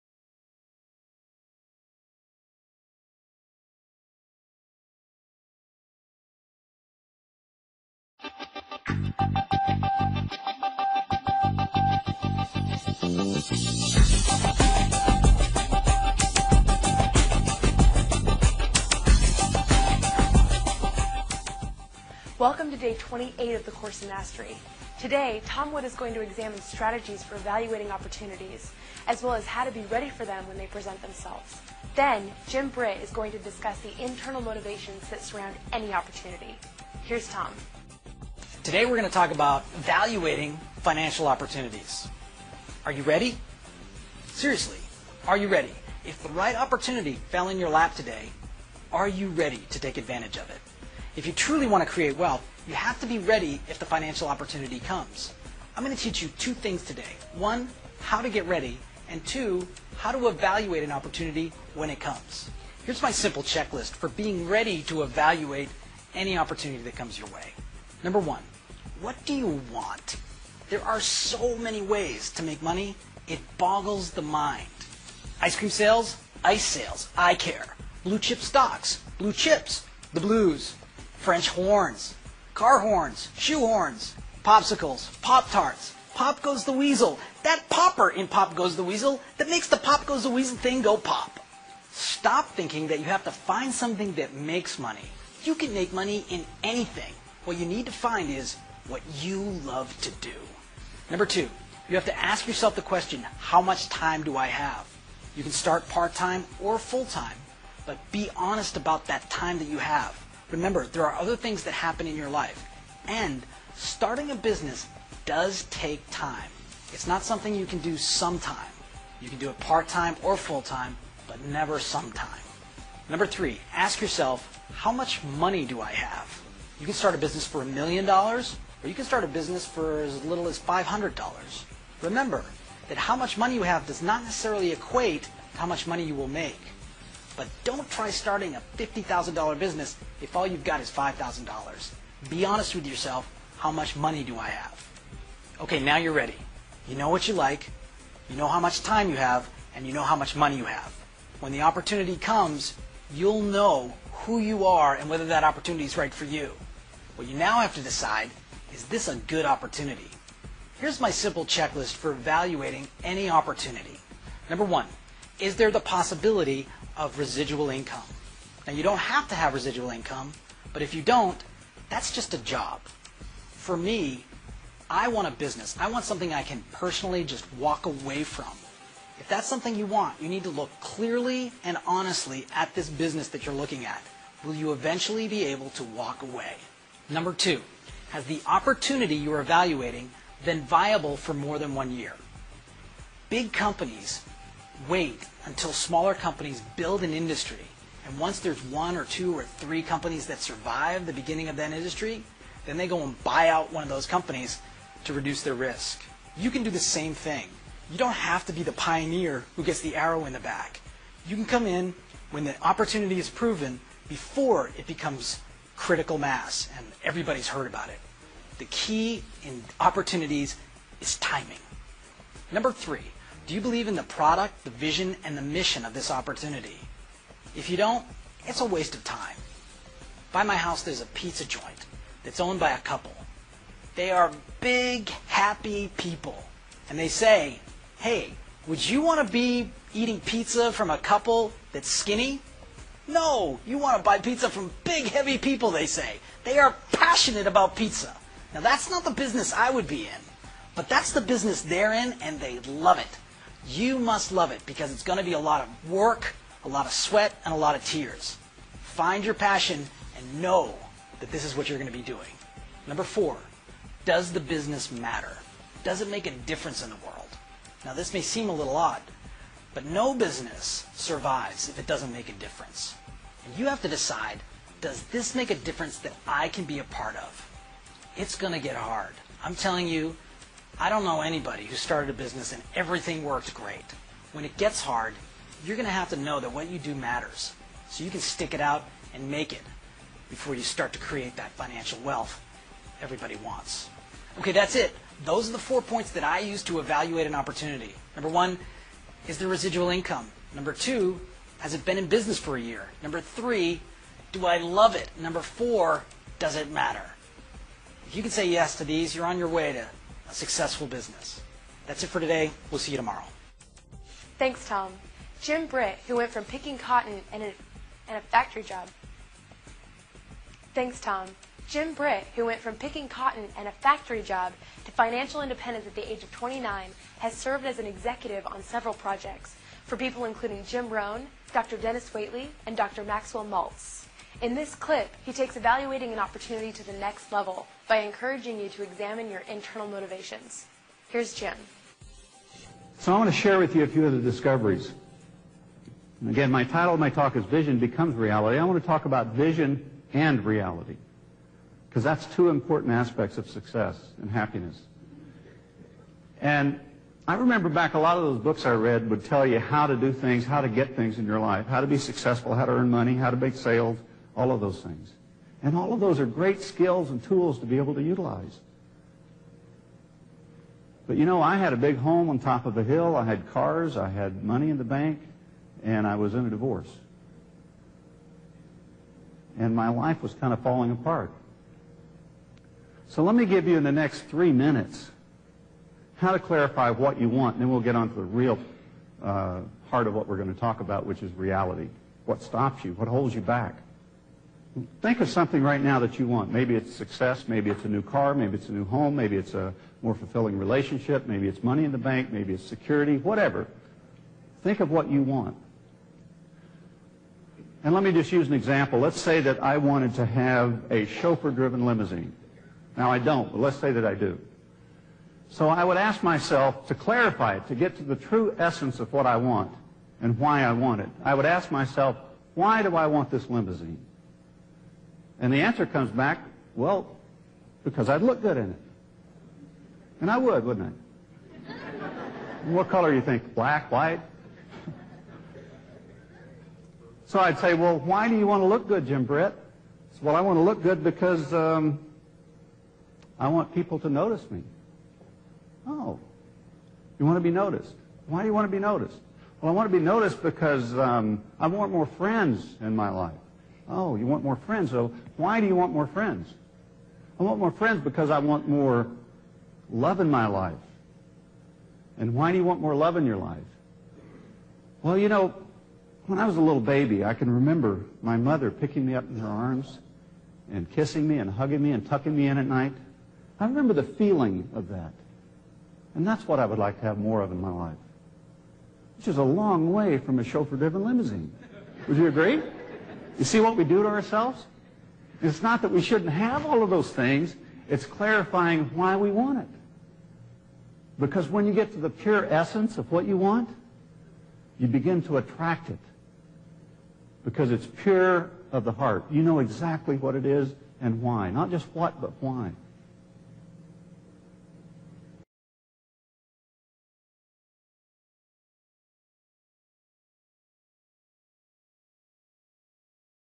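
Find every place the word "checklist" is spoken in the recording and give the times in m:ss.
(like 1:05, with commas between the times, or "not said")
1:03, 2:41.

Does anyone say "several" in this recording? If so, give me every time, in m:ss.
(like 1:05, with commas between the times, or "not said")
5:28.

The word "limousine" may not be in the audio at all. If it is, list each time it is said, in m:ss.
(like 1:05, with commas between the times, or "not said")
6:51, 7:03, 8:01.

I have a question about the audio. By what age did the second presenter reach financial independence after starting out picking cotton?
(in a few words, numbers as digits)
29.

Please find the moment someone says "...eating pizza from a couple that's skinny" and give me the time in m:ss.
3:59.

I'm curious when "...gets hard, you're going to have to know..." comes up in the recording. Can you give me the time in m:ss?
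4:44.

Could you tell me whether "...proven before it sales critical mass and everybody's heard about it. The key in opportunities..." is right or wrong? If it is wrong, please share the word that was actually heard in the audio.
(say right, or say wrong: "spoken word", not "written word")
wrong: "becomes", not "sales".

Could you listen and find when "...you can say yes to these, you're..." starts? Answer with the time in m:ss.
5:08.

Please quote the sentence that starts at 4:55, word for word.
Those are the four points that I use to evaluate an opportunity.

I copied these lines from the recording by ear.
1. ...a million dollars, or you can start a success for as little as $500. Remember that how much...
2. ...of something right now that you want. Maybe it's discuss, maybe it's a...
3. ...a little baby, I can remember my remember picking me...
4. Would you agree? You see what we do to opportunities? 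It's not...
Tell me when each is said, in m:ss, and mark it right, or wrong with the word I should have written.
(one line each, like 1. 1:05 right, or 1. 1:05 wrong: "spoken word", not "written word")
1. 2:07 wrong: "business", not "success"
2. 6:35 wrong: "success", not "discuss"
3. 7:46 wrong: "mother", not "remember"
4. 8:02 wrong: "ourselves", not "opportunities".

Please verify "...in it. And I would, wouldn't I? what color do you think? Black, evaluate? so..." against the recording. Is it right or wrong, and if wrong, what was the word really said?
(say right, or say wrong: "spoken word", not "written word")
wrong: "white", not "evaluate".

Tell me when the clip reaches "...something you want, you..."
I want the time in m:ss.
2:59.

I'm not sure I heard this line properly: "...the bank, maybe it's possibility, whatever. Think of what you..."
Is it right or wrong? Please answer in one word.
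wrong.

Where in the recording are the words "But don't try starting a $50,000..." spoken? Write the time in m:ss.
2:17.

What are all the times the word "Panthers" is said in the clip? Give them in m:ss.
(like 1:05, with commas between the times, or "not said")
not said.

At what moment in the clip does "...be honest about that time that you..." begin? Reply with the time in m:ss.
1:48.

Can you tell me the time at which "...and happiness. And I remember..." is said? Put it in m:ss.
5:54.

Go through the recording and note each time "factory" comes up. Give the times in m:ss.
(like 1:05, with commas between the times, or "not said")
5:18, 5:23.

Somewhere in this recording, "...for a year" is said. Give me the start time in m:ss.
5:02.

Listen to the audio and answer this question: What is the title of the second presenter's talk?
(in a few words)
Vision Becomes Reality.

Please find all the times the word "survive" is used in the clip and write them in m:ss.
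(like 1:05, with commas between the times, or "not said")
3:20, 4:30.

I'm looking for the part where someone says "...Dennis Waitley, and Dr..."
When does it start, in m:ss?
5:31.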